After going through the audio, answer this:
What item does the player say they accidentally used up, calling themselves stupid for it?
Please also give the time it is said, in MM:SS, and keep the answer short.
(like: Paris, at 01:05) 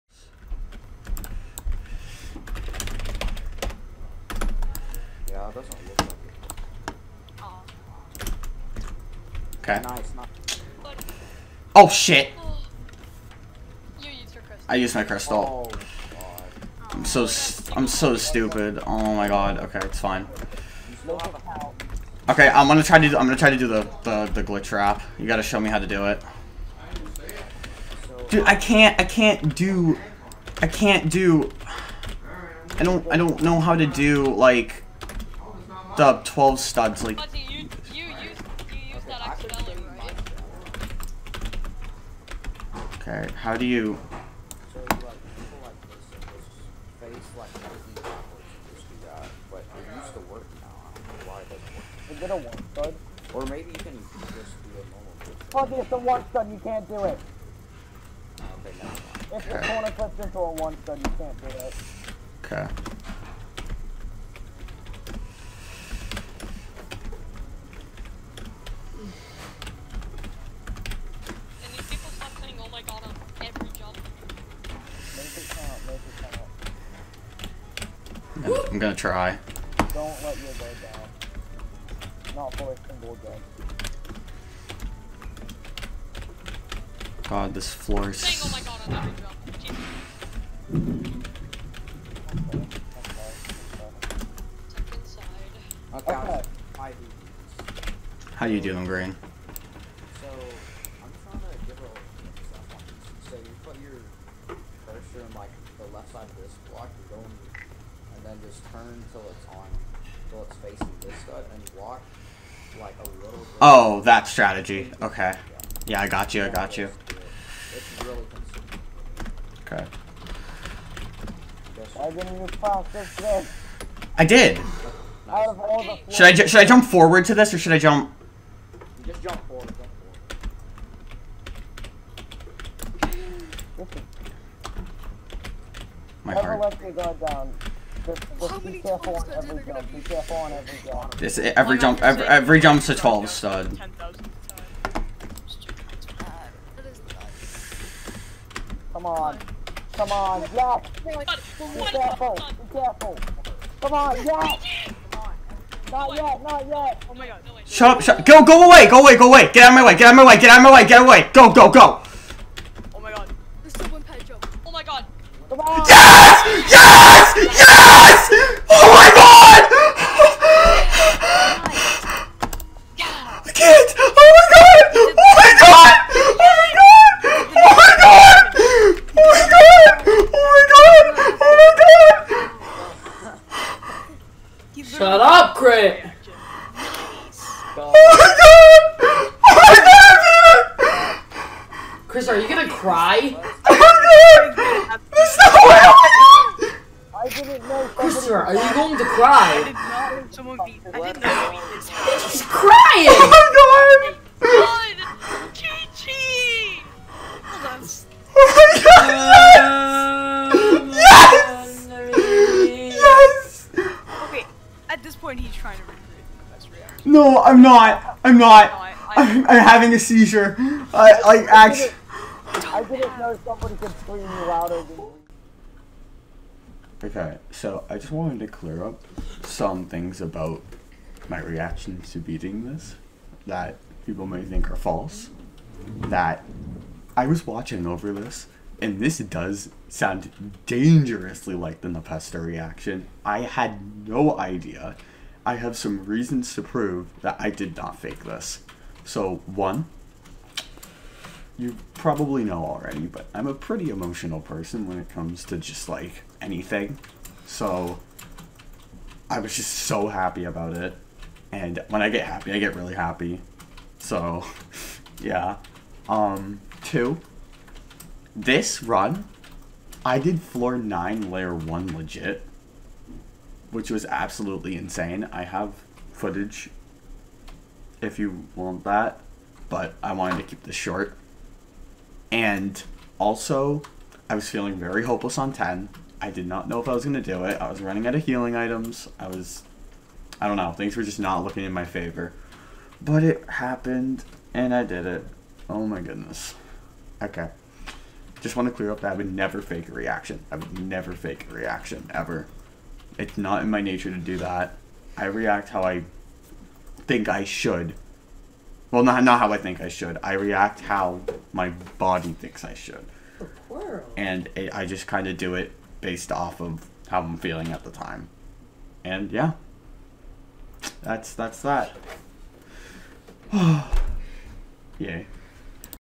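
crystal, at 00:15.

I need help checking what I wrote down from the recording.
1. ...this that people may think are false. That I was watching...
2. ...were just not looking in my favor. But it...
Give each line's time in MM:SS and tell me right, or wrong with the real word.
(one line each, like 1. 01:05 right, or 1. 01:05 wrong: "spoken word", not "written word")
1. 03:52 right
2. 04:50 right.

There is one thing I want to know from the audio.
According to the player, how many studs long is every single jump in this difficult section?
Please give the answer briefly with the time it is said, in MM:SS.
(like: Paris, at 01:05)
12, at 02:22.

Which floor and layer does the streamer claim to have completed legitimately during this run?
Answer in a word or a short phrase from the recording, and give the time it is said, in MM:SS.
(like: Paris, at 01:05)
floor 9 layer 1, at 04:30.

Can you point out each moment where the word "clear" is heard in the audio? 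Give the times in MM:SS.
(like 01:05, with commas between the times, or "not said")
03:48, 04:58.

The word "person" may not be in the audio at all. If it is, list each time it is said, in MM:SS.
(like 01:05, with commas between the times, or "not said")
04:14.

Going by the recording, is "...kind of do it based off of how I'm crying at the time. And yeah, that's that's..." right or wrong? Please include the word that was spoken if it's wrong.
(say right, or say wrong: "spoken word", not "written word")
wrong: "feeling", not "crying".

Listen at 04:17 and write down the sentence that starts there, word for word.
So, I was just so happy about it.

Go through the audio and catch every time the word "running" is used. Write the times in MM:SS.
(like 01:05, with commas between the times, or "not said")
04:47.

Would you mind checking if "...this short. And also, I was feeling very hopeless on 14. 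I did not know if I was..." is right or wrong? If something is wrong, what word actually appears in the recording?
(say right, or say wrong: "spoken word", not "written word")
wrong: "10", not "14".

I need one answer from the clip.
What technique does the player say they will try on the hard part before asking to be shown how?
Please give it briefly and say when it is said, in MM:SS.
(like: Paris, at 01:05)
glitch wrap, at 00:24.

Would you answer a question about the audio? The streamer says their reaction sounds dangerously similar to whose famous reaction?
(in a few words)
Npesta.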